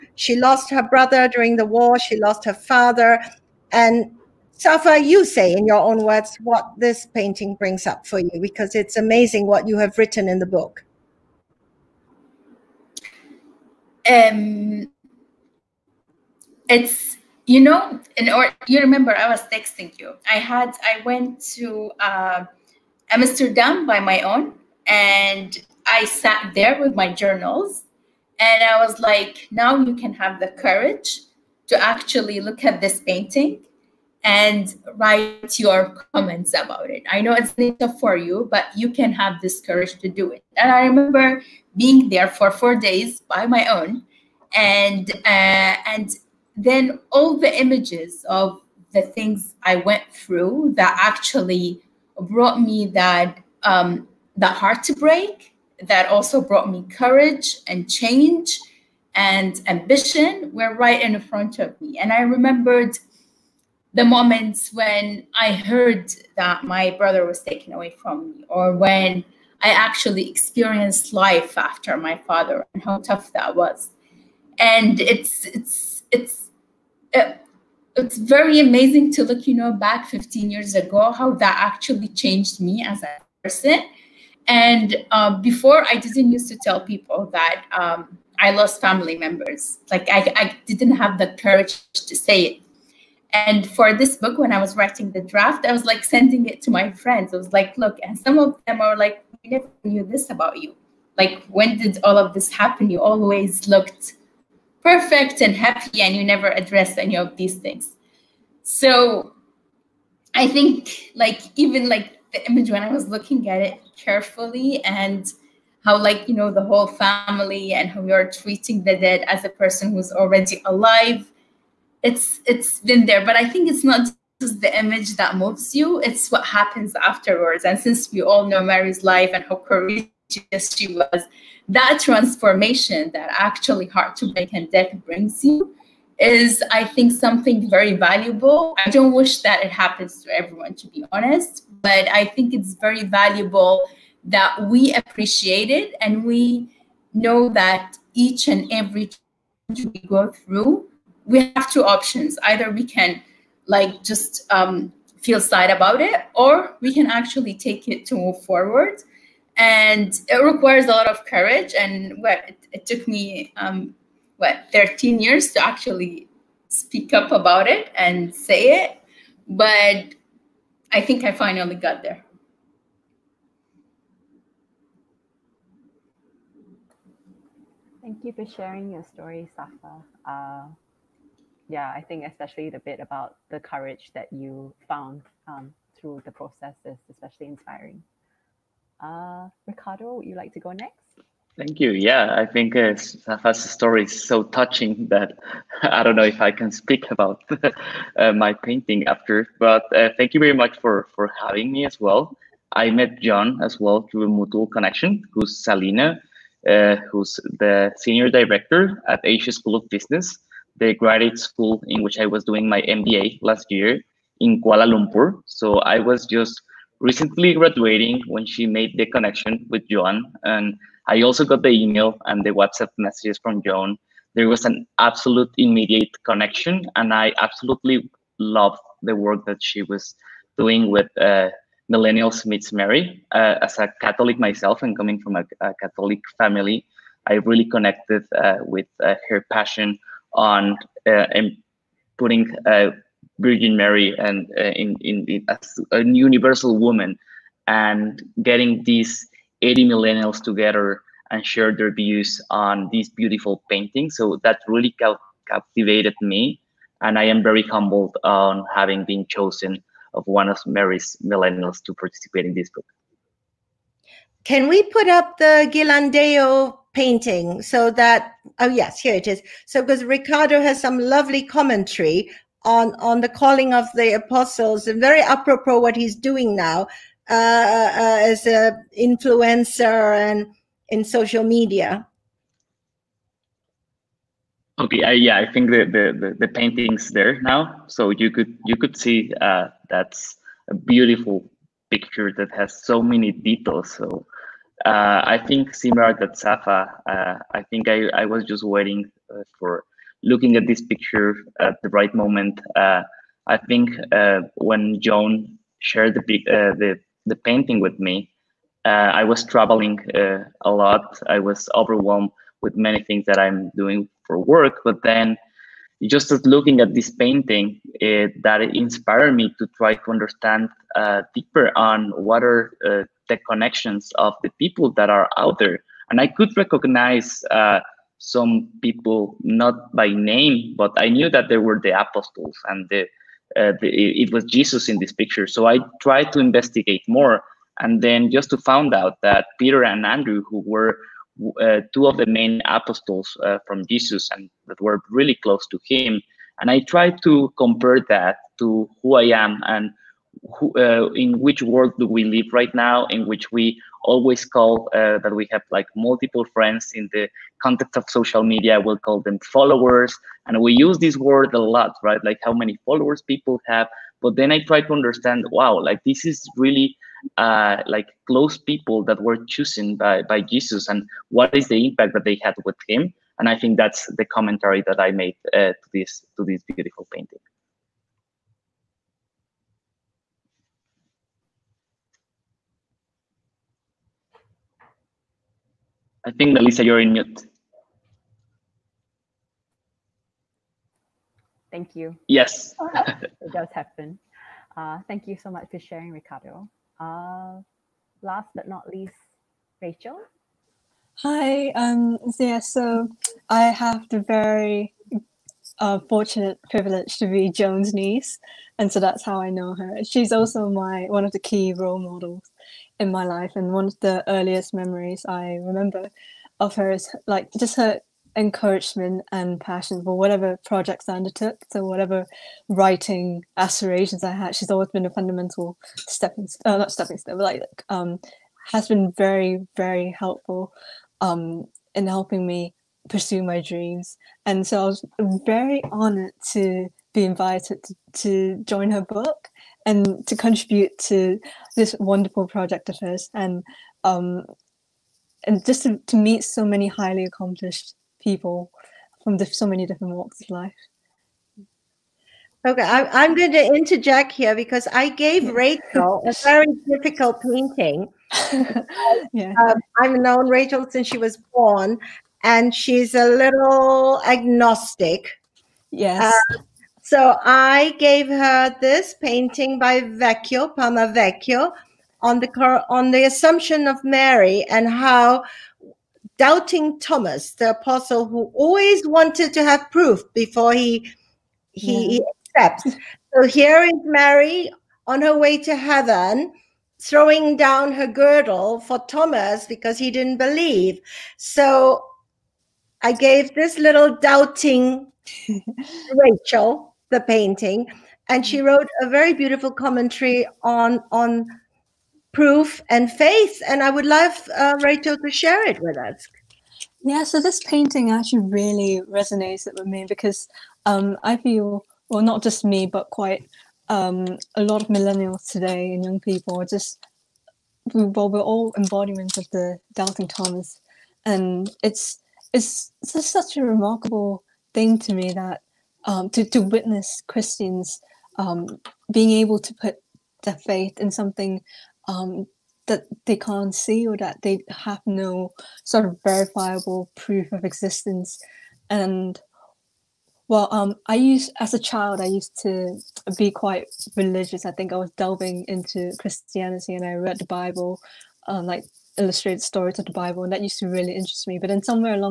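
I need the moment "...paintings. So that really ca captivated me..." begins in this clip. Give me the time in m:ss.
4:13.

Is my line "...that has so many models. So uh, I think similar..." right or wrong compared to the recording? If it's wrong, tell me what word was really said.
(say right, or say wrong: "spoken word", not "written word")
wrong: "details", not "models".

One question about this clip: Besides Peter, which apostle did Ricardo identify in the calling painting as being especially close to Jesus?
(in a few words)
Andrew.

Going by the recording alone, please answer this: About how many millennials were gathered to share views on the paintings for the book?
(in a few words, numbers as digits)
80.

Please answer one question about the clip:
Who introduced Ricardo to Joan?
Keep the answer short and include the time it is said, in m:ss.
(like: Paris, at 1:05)
Salina, at 3:25.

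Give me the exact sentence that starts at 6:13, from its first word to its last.
And I think that's the commentary that I made uh, to this to this beautiful painting.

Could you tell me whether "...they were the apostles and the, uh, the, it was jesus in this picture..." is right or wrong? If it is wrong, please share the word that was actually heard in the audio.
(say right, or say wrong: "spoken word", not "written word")
right.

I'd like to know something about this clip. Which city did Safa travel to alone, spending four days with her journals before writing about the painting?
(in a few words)
Amsterdam.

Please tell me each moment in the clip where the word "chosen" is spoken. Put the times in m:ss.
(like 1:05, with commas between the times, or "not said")
4:19, 6:09.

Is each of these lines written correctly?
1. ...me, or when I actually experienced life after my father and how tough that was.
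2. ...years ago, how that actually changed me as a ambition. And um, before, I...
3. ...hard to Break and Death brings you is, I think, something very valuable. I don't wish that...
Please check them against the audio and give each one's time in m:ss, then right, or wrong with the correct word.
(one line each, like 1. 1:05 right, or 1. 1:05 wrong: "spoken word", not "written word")
1. 1:08 right
2. 1:20 wrong: "person", not "ambition"
3. 2:13 right.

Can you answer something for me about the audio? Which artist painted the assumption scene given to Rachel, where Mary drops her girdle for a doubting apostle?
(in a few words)
Palma Vecchio.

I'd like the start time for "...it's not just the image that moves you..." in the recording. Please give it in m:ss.
2:03.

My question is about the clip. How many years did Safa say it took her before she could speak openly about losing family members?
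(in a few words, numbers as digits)
13.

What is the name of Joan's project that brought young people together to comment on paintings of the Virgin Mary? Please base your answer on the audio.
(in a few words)
Millennials Meets Mary.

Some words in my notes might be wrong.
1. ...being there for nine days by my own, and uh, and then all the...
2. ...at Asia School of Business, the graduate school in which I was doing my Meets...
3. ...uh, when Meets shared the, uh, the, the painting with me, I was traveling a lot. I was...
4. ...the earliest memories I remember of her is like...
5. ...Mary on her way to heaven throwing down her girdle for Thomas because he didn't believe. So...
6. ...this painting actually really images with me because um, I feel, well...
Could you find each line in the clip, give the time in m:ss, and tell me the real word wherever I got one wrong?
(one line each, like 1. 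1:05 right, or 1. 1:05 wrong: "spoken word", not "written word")
1. 0:41 wrong: "four", not "nine"
2. 3:29 wrong: "MBA", not "Meets"
3. 5:04 wrong: "Joan", not "Meets"
4. 6:53 right
5. 8:04 right
6. 8:27 wrong: "resonates", not "images".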